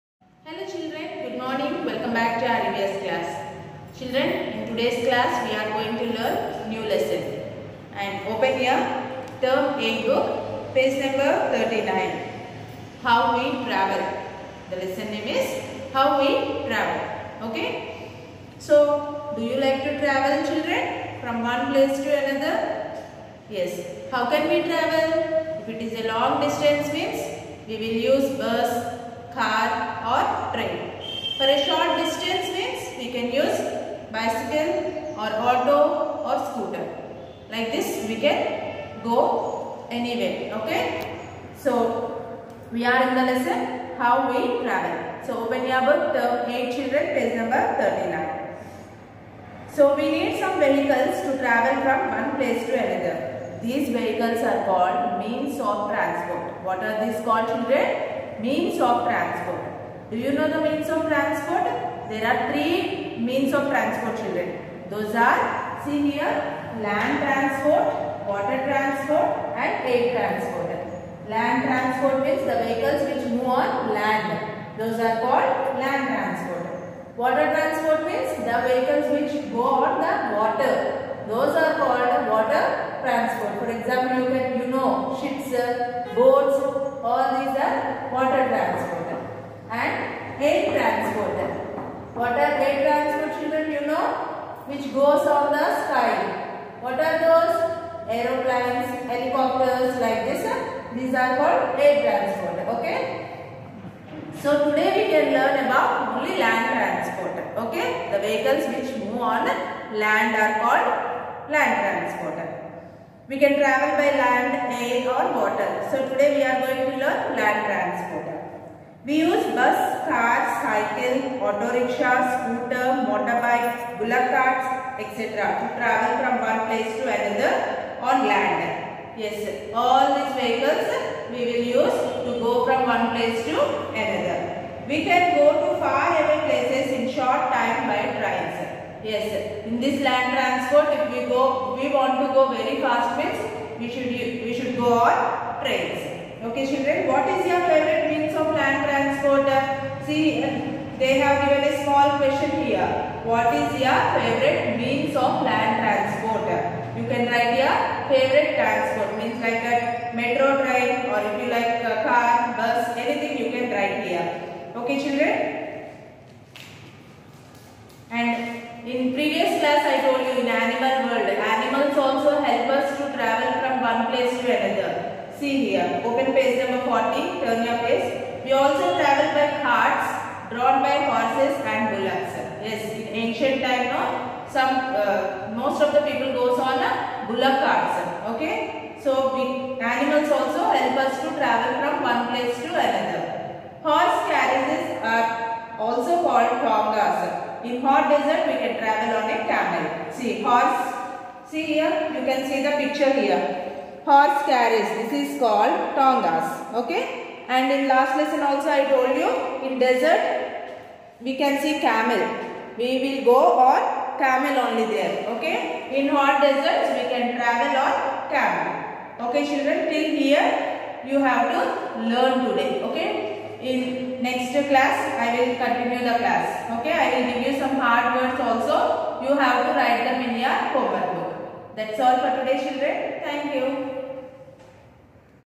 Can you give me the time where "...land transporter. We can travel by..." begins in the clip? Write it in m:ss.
1:51.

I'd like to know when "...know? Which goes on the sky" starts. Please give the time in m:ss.
1:33.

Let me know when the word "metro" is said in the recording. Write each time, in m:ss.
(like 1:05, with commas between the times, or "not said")
2:40.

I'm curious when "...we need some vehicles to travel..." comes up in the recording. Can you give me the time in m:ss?
0:49.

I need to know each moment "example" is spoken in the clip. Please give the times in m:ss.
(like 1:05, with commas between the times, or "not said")
1:23.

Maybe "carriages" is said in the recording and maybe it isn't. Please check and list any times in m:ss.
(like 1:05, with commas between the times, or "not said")
3:14, 3:24.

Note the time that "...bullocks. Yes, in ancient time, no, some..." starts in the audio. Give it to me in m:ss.
3:01.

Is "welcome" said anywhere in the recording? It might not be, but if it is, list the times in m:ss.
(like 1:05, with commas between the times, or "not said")
0:01.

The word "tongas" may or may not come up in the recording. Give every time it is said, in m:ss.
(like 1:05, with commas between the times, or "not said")
3:16, 3:25.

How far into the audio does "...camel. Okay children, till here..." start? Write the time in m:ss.
3:38.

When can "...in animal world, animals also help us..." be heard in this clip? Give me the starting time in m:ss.
2:50.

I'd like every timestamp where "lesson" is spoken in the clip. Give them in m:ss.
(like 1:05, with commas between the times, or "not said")
0:06, 0:14, 0:43, 3:28.